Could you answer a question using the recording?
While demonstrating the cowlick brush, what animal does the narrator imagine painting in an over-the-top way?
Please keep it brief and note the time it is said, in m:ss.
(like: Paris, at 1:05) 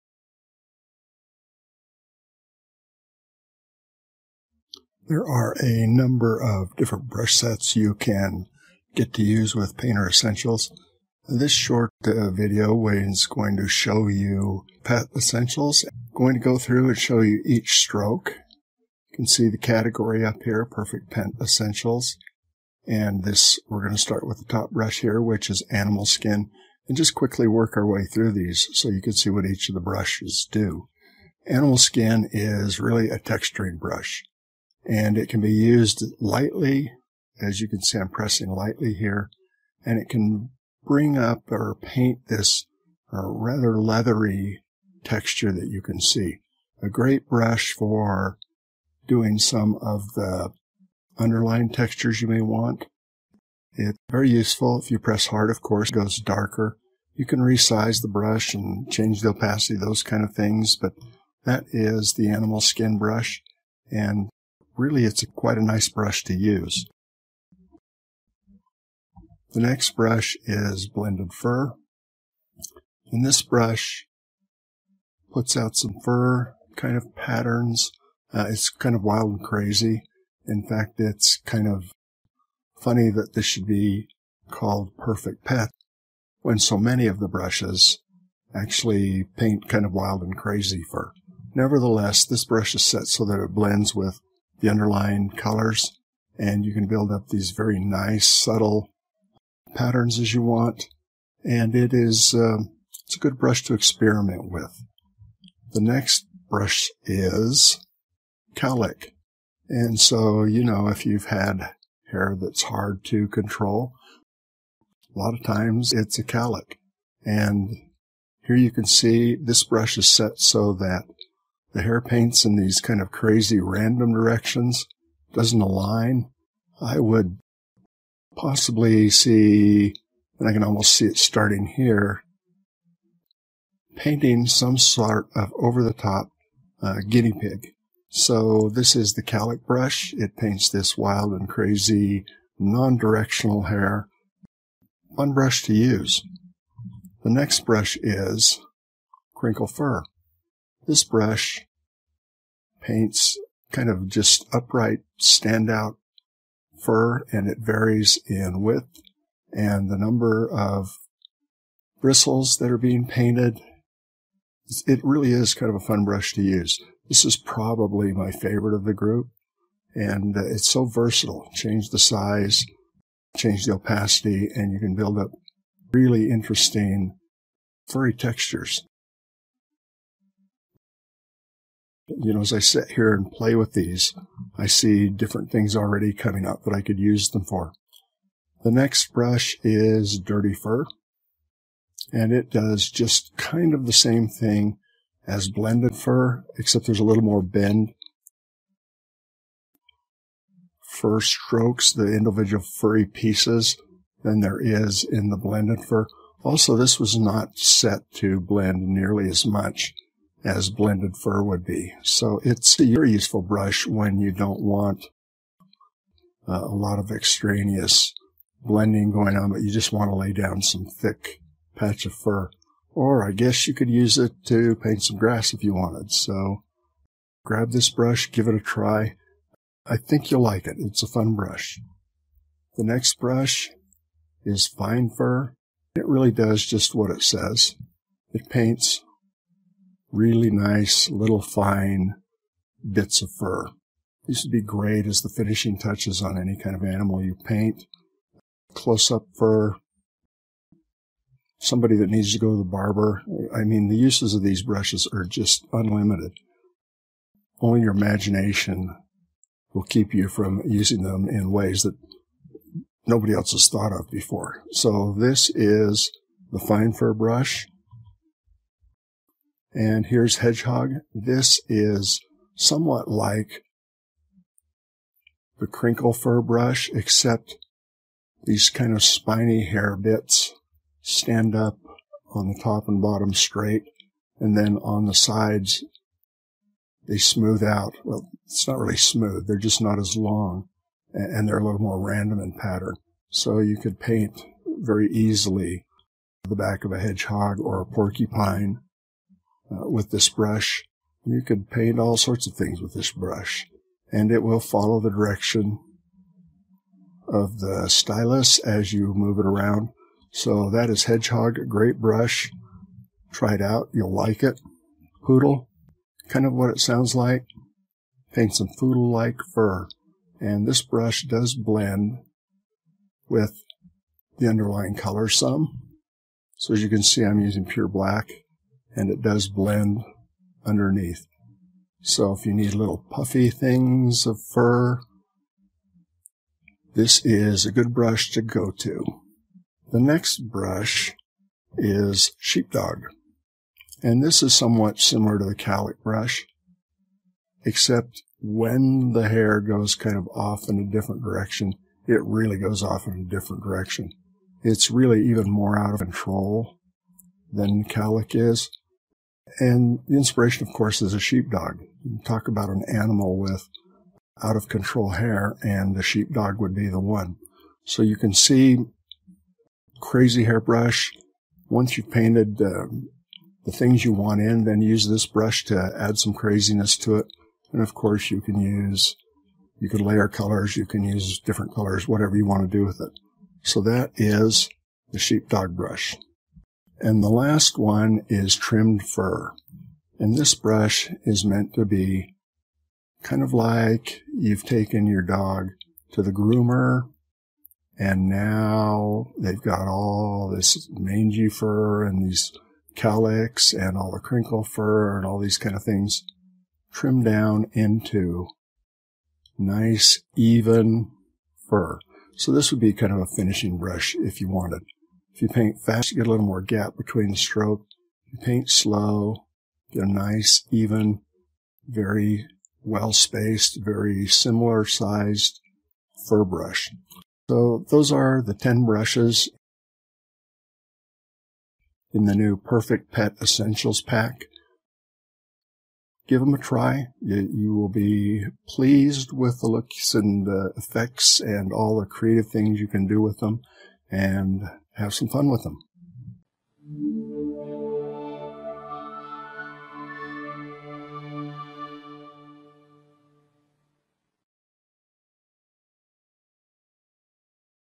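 Guinea pig, at 2:17.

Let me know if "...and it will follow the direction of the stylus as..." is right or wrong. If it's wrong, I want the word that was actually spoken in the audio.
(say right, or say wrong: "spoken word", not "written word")
right.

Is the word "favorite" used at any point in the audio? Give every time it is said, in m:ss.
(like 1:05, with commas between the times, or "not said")
2:48.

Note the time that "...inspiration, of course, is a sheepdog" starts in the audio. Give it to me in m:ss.
6:00.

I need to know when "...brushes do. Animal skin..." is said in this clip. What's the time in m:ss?
0:29.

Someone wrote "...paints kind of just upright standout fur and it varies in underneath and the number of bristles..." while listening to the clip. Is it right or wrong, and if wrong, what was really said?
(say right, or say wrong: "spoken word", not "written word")
wrong: "width", not "underneath".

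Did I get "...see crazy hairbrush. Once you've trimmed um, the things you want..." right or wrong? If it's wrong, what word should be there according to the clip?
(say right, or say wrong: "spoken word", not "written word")
wrong: "painted", not "trimmed".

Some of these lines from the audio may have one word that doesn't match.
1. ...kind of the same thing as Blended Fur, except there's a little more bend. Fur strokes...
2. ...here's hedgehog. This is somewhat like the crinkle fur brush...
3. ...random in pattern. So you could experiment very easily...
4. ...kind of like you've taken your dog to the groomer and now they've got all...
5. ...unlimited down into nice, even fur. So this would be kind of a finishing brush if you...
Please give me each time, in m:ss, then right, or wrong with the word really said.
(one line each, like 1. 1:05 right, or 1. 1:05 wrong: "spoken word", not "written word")
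1. 3:13 right
2. 4:30 right
3. 4:51 wrong: "paint", not "experiment"
4. 6:33 right
5. 6:46 wrong: "trimmed", not "unlimited".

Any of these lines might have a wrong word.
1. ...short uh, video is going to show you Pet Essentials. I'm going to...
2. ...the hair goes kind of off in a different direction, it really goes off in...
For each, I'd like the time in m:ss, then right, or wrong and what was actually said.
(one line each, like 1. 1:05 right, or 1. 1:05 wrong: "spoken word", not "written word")
1. 0:11 right
2. 5:49 right.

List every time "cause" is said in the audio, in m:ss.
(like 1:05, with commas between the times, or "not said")
not said.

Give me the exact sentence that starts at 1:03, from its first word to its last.
And really it's a, quite a nice brush to use.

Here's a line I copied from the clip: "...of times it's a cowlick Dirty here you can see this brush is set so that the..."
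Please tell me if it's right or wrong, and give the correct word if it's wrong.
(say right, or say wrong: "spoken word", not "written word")
wrong: "And", not "Dirty".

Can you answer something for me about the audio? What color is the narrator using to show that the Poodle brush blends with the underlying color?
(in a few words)
Black.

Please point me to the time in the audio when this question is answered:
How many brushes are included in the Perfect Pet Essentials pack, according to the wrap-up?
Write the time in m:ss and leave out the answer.
7:08.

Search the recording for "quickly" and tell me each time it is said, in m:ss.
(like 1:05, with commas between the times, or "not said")
0:27.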